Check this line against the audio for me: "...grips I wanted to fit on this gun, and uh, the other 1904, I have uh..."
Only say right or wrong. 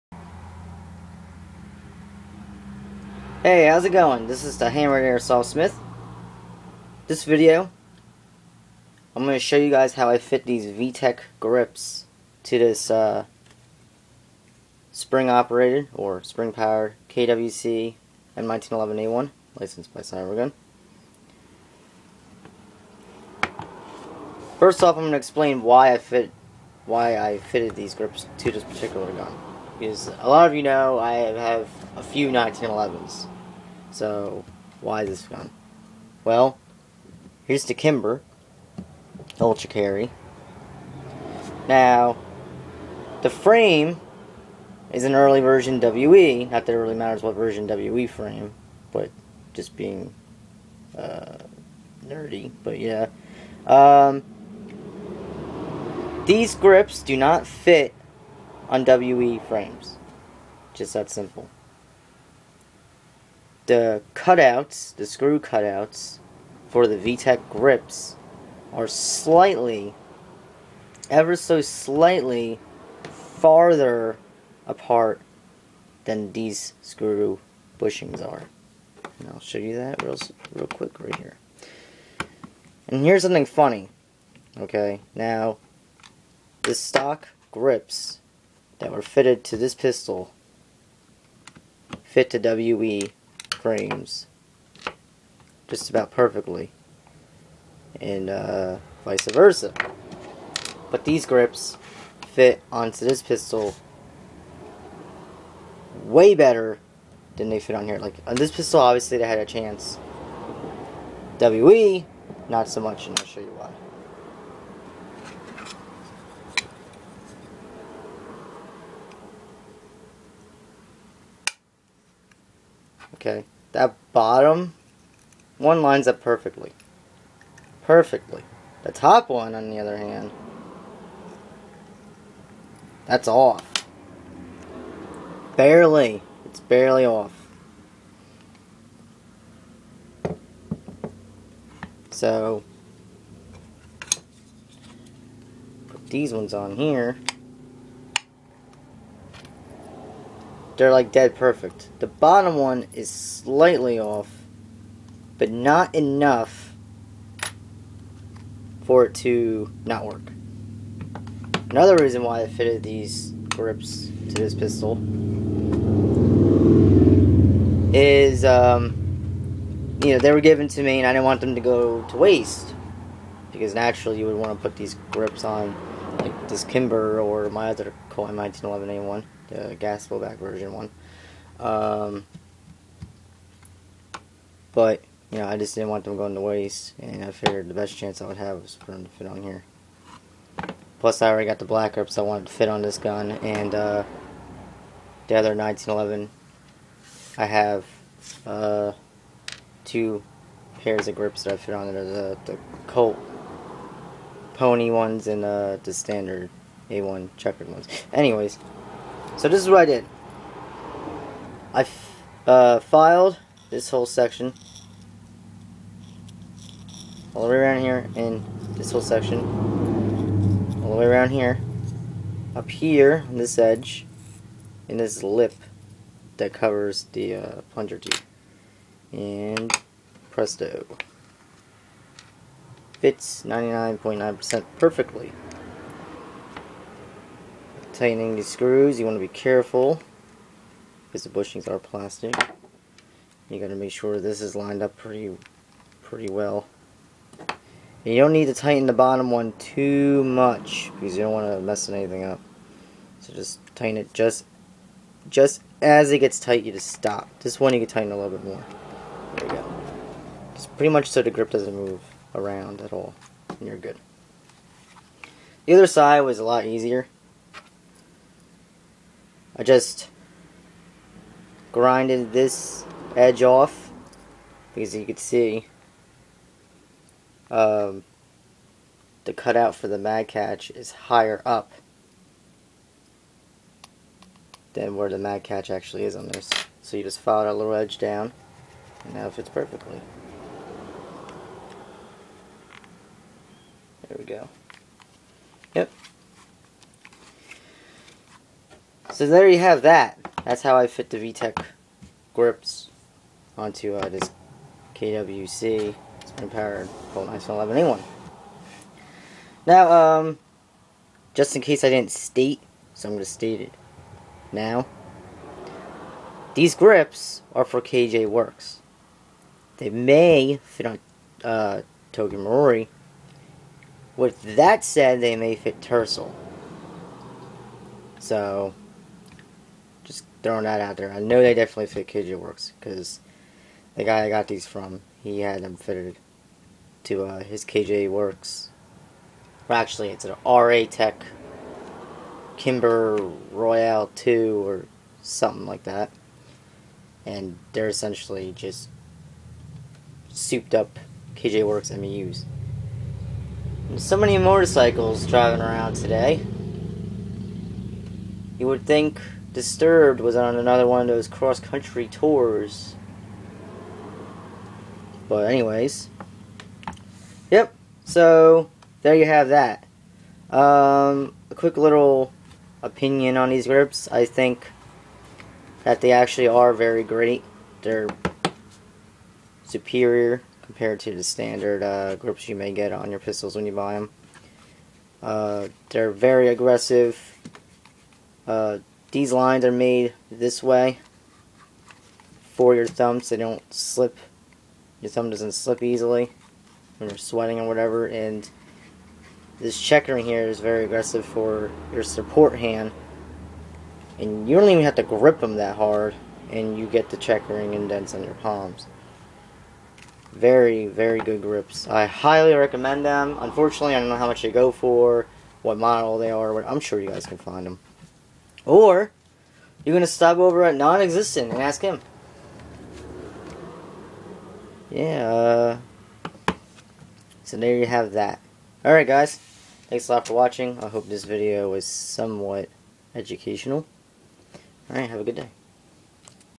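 wrong.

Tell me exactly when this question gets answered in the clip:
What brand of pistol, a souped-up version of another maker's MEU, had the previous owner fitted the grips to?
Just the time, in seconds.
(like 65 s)
340 s.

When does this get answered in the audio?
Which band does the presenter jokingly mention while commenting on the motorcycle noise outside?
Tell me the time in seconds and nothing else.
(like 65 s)
359 s.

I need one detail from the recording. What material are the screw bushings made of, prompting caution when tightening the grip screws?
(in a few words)
Plastic.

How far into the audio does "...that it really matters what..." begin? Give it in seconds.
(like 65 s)
46 s.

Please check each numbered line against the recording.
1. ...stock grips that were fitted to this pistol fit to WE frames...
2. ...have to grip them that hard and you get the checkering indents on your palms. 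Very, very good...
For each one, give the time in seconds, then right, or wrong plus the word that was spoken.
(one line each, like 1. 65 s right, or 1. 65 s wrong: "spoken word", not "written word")
1. 86 s right
2. 404 s right.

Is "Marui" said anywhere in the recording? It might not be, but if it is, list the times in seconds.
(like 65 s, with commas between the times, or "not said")
322 s.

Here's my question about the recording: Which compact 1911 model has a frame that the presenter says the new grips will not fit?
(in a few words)
Kimber Ultra Carry.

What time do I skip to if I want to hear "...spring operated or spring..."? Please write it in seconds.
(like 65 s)
14 s.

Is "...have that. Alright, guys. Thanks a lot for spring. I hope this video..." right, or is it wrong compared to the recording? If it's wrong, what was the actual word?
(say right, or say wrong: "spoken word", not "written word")
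wrong: "watching", not "spring".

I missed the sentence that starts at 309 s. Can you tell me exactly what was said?
Now, um, just in case I didn't state, so I'm going to state it now.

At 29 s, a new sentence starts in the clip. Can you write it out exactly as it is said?
Because a lot of you know I have a few 1911s.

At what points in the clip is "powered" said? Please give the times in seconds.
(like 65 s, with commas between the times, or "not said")
16 s, 306 s.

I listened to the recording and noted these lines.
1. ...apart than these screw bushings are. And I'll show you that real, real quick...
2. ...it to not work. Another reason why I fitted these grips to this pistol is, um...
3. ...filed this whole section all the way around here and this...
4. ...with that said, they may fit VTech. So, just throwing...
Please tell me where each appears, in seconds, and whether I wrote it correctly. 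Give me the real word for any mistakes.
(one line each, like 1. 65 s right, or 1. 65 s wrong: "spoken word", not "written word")
1. 74 s right
2. 159 s right
3. 212 s right
4. 324 s wrong: "Tersel", not "VTech".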